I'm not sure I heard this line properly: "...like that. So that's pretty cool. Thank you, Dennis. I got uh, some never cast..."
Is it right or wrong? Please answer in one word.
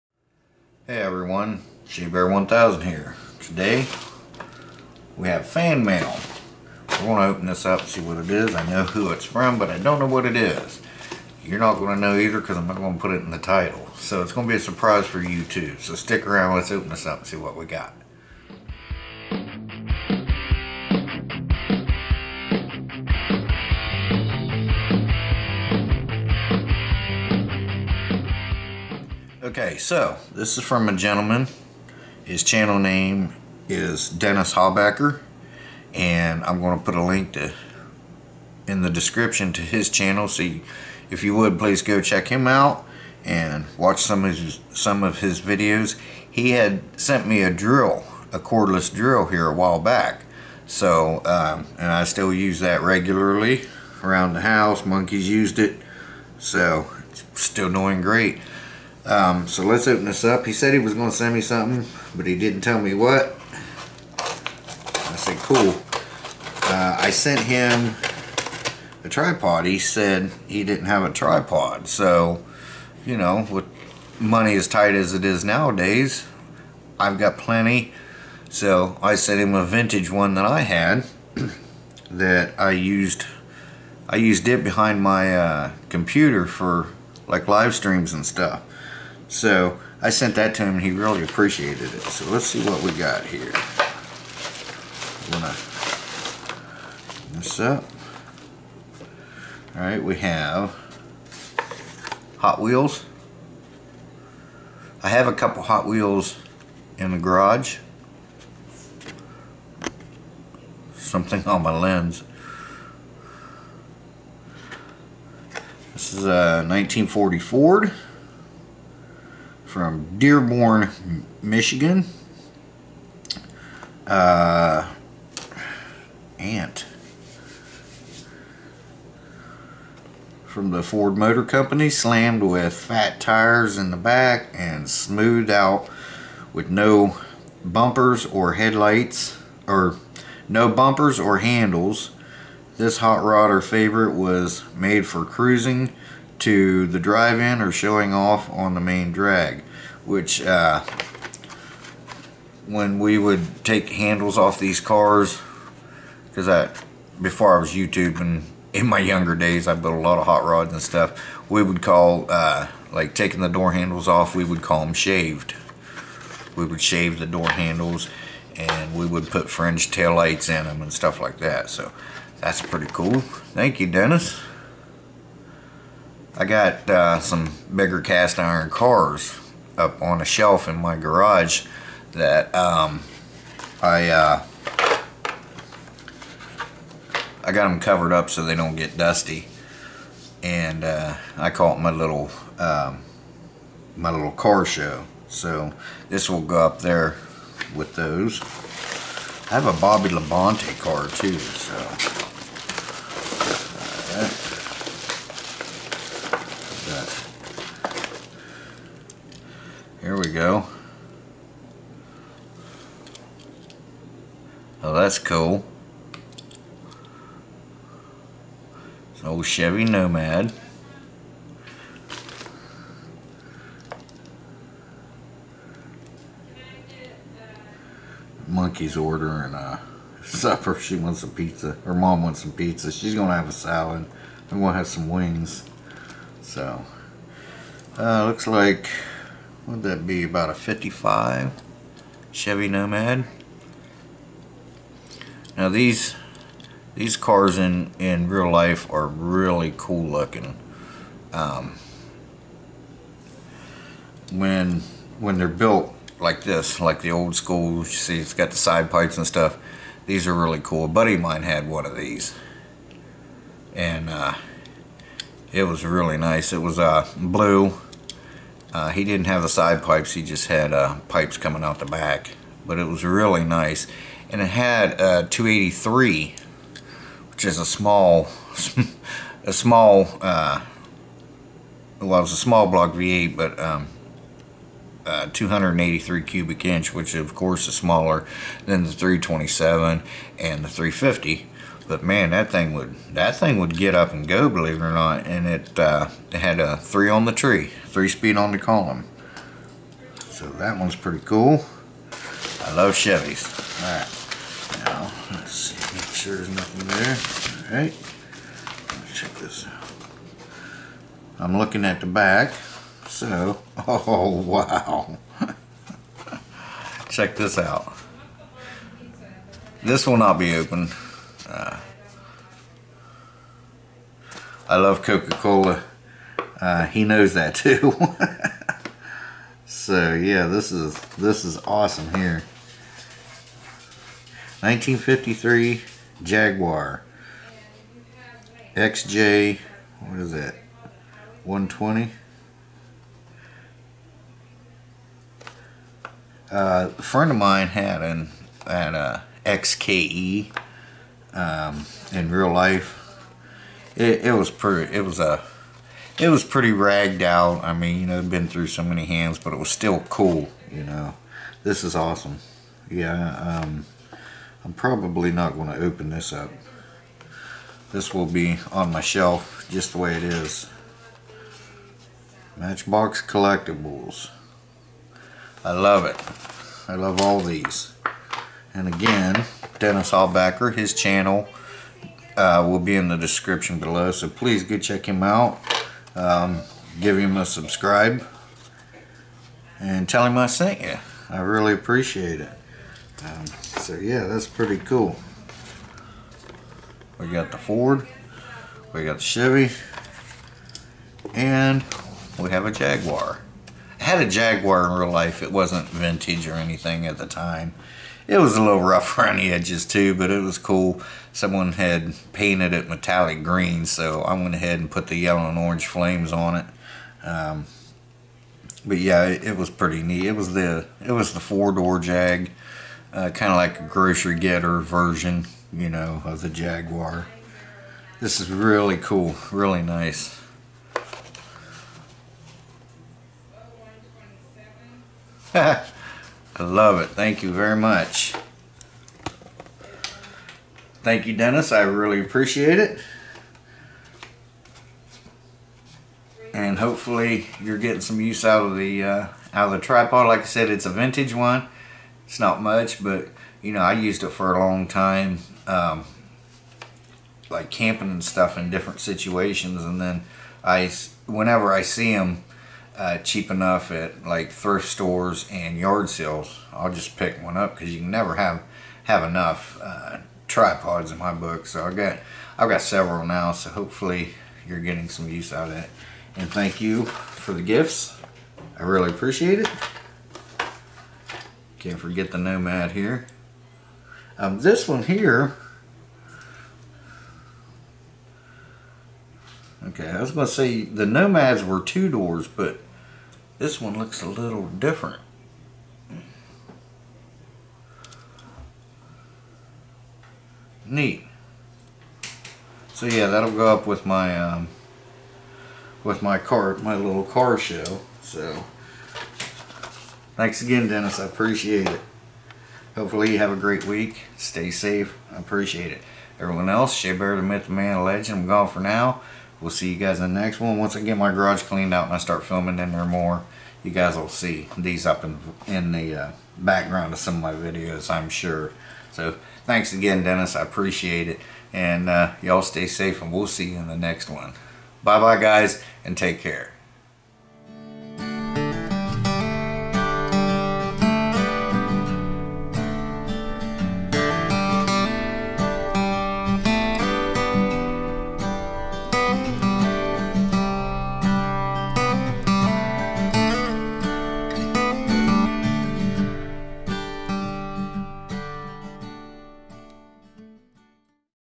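wrong.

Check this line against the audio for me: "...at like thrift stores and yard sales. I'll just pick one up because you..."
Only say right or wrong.
right.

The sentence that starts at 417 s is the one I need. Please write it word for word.
Um, but yeah, it, it, was pretty neat.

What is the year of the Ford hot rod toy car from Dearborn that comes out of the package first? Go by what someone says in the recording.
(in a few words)
1940.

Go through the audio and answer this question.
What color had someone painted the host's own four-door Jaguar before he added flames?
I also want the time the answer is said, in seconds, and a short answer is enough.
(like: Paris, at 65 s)
Metallic green, at 412 s.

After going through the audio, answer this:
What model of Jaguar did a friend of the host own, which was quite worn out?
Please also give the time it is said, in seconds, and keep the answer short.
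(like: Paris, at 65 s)
XKE, at 349 s.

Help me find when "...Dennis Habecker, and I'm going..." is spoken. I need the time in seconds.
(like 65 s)
34 s.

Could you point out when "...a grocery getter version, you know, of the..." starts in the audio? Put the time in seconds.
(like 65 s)
423 s.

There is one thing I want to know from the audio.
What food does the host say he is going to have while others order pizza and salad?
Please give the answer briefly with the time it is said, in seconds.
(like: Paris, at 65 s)
Wings, at 235 s.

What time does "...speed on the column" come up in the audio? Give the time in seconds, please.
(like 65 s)
298 s.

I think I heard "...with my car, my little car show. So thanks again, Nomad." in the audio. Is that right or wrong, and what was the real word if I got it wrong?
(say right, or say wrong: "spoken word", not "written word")
wrong: "Dennis", not "Nomad".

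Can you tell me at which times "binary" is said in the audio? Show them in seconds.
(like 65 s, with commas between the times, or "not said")
not said.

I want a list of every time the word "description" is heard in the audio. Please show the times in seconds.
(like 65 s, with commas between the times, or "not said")
38 s, 383 s.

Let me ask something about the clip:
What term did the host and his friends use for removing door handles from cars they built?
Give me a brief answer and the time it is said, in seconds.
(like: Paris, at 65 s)
Shaved, at 164 s.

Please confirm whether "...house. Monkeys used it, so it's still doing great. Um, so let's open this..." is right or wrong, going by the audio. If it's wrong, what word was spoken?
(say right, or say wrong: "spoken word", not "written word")
right.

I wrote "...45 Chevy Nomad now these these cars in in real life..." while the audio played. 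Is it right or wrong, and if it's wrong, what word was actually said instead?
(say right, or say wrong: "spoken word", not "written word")
wrong: "55", not "45".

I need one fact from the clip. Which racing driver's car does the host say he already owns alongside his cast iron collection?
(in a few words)
Bobby Labonte.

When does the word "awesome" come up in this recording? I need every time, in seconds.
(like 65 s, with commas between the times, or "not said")
331 s, 361 s.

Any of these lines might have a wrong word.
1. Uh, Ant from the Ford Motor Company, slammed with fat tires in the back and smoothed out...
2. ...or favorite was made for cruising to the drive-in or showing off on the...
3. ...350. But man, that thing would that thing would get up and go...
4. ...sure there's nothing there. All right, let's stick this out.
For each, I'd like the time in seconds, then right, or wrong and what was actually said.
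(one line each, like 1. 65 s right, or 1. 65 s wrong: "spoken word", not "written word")
1. 124 s right
2. 143 s right
3. 290 s right
4. 306 s wrong: "check", not "stick".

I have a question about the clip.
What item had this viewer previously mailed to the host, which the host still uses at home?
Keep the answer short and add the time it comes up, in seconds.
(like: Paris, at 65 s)
Cordless drill, at 48 s.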